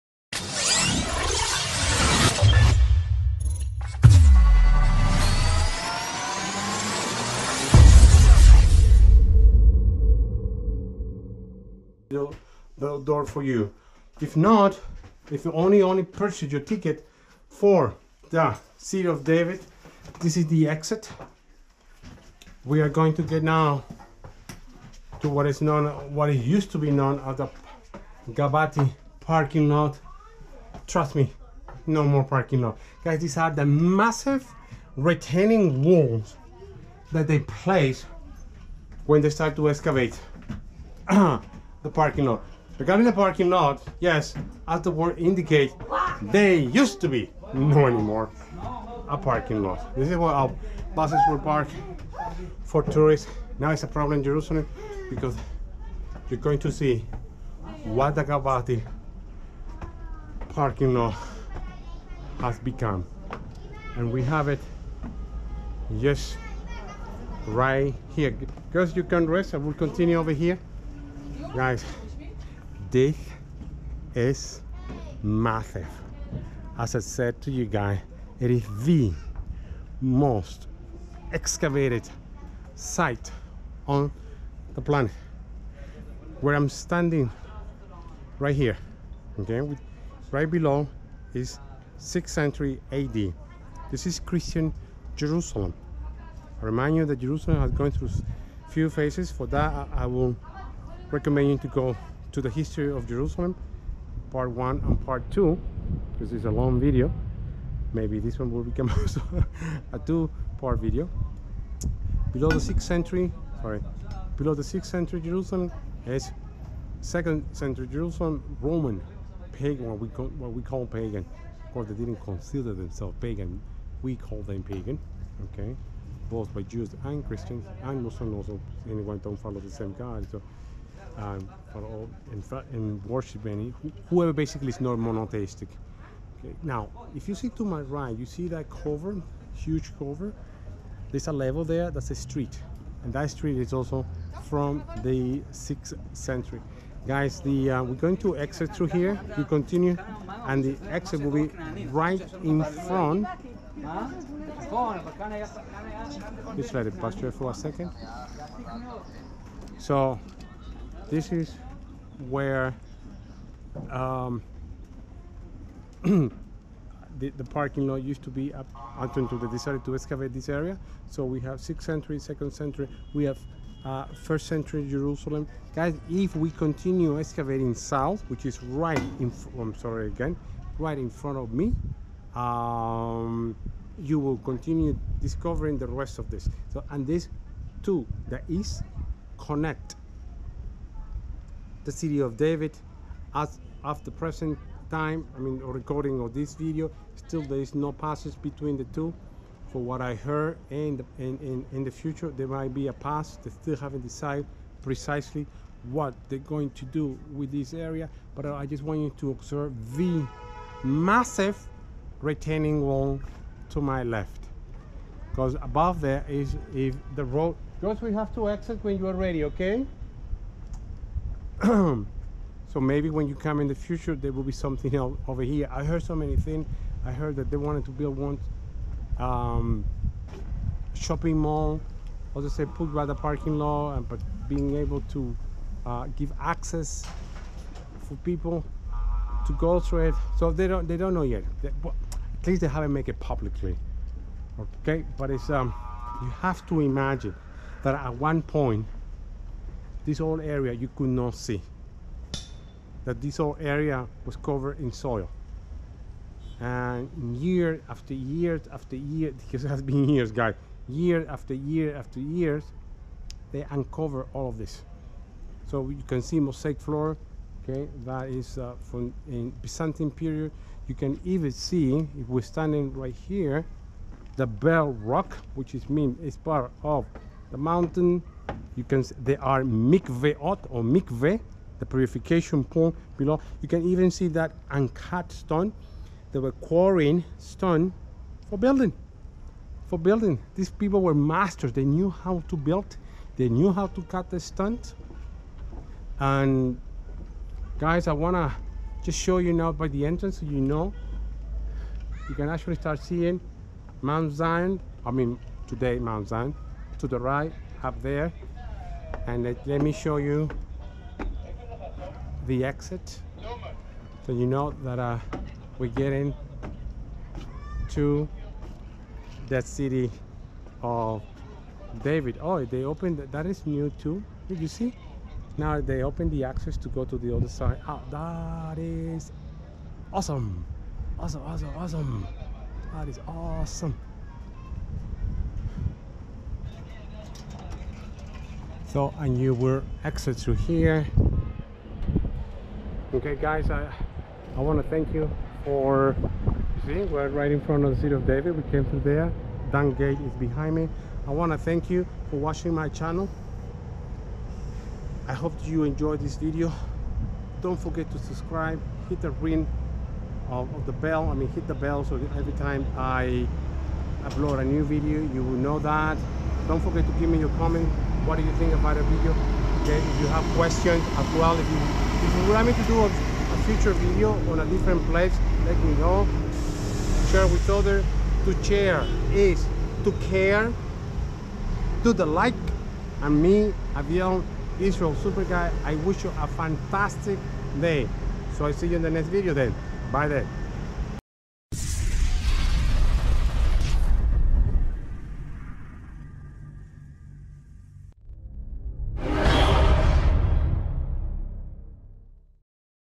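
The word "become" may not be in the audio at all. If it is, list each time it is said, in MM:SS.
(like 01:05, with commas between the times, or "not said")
01:02, 01:48.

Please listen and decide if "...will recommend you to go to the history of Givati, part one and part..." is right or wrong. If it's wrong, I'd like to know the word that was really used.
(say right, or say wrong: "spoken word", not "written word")
wrong: "Jerusalem", not "Givati".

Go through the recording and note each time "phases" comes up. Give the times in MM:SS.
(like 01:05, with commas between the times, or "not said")
01:38.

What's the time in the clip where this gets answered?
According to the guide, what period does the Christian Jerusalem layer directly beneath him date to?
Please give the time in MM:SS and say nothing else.
01:31.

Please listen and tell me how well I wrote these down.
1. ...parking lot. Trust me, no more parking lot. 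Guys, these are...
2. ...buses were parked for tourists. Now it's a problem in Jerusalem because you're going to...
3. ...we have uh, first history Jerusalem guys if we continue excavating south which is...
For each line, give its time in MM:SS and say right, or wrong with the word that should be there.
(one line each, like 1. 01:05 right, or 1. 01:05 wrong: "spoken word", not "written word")
1. 00:29 right
2. 00:50 right
3. 02:53 wrong: "century", not "history".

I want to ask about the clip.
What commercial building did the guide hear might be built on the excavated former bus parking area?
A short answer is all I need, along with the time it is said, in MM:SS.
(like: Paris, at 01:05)
Shopping mall, at 03:50.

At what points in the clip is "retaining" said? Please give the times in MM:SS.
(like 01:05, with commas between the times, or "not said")
00:34, 03:32.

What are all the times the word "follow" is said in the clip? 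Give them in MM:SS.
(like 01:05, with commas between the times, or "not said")
02:09.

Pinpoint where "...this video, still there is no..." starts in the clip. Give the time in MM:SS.
03:16.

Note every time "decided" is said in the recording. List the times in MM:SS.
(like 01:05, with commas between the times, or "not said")
02:49, 03:24.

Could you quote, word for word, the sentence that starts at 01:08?
Because you can rest, I will continue over here.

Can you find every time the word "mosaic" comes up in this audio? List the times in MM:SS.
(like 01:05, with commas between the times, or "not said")
04:26.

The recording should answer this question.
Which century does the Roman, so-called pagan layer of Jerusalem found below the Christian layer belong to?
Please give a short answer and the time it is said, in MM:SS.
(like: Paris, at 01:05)
Second century, at 01:57.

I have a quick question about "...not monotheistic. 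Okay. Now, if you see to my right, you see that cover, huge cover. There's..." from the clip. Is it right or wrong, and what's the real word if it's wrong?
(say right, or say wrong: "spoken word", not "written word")
right.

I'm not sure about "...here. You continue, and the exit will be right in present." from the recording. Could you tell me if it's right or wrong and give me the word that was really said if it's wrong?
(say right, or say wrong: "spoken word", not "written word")
wrong: "front", not "present".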